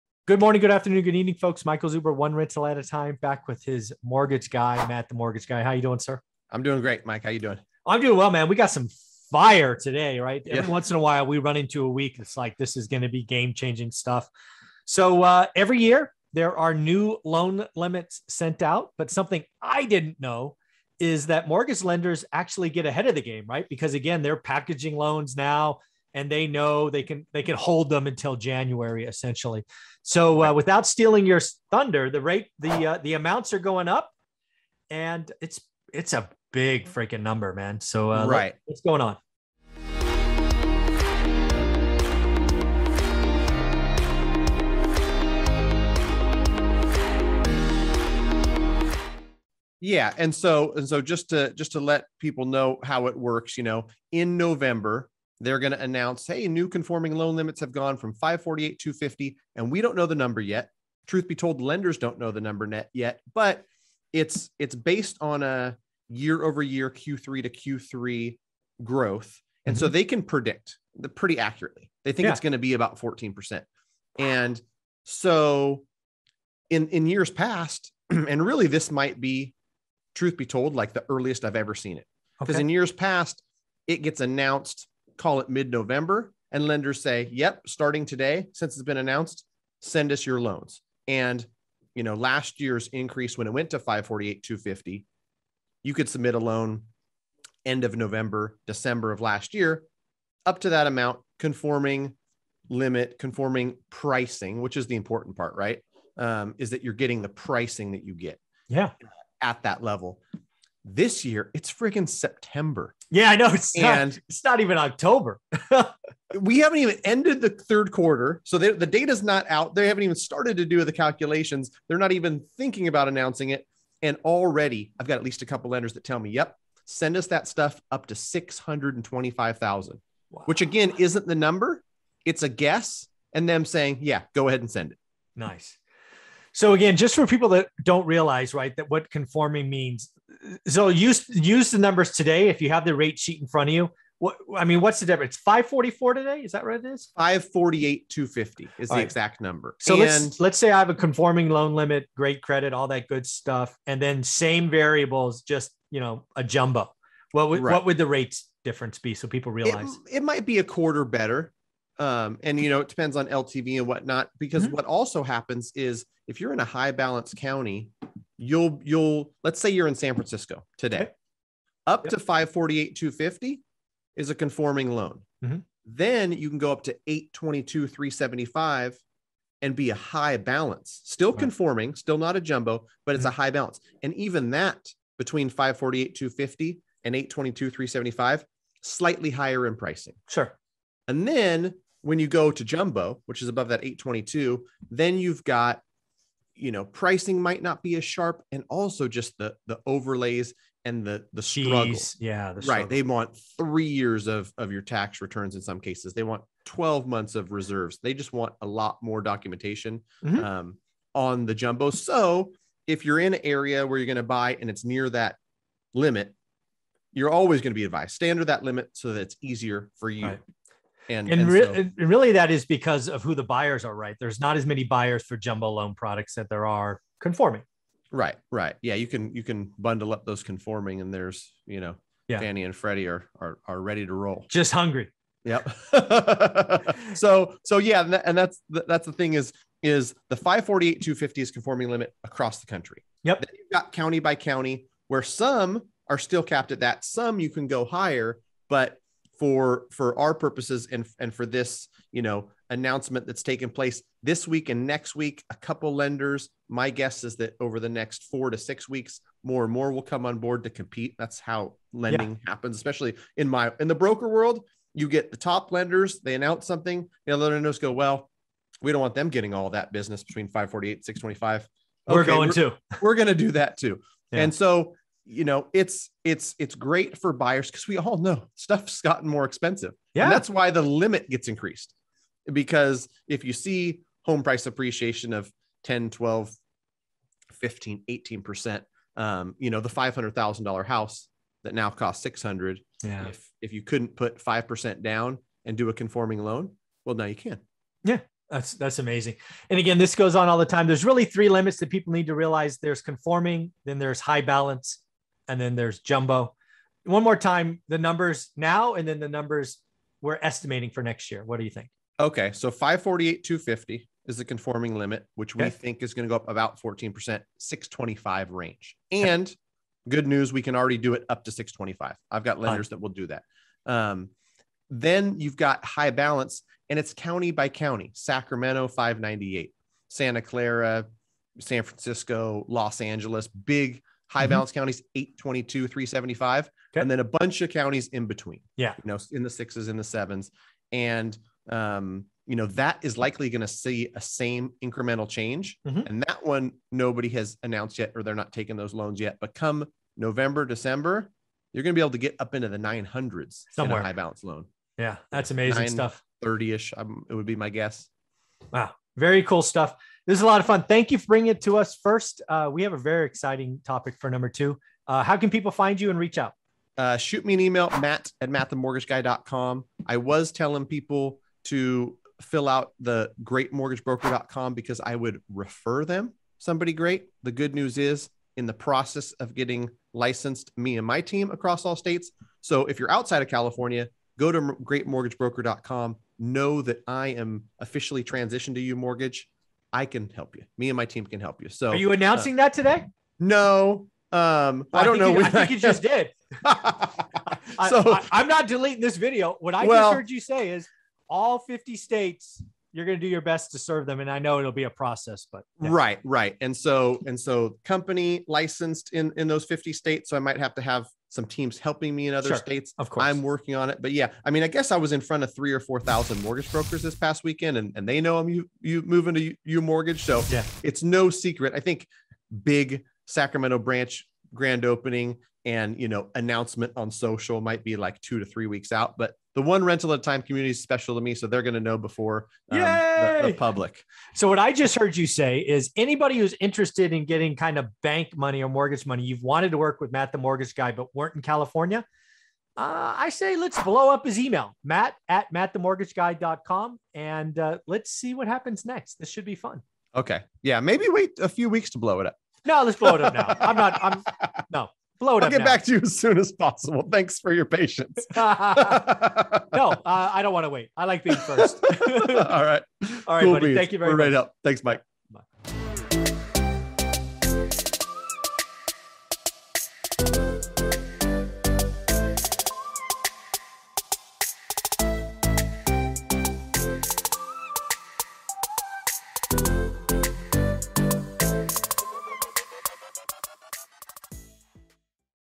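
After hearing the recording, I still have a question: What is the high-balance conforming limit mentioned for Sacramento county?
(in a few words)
598.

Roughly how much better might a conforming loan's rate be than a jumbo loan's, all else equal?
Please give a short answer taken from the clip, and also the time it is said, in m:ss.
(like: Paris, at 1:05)
A quarter, at 2:40.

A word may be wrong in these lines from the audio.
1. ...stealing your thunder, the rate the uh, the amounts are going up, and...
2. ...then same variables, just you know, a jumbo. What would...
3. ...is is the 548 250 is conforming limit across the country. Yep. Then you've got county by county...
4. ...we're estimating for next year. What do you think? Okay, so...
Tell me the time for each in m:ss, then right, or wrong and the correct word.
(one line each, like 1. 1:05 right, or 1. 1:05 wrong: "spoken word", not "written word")
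1. 0:30 right
2. 2:34 right
3. 3:59 right
4. 5:10 right.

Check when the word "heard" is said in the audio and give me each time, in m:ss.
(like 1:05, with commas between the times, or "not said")
6:40, 7:14.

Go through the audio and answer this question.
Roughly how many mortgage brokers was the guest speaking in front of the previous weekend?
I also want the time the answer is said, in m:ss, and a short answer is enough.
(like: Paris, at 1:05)
3,000 or 4,000, at 6:55.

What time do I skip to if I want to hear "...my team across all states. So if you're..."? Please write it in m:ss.
6:21.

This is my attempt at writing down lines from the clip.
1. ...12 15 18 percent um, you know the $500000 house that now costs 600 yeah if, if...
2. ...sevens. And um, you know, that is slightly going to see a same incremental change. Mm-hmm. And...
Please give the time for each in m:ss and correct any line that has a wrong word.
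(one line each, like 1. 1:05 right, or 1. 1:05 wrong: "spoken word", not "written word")
1. 4:46 right
2. 5:40 wrong: "likely", not "slightly".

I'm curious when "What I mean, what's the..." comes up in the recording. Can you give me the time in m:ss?
2:24.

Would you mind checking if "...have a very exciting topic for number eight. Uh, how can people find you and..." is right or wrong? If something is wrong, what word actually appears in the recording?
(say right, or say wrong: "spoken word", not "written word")
wrong: "two", not "eight".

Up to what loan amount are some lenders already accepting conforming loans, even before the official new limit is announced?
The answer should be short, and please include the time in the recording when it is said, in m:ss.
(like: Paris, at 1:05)
625,000, at 2:08.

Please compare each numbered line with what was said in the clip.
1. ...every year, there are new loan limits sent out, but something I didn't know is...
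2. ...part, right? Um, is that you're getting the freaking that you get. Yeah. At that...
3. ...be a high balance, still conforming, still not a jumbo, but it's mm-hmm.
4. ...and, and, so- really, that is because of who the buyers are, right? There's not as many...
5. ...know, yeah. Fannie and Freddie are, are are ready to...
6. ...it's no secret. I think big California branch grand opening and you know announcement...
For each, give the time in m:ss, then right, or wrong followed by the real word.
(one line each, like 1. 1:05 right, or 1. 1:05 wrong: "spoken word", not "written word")
1. 0:15 right
2. 1:45 wrong: "pricing", not "freaking"
3. 2:59 right
4. 3:41 right
5. 3:51 right
6. 7:00 wrong: "Sacramento", not "California".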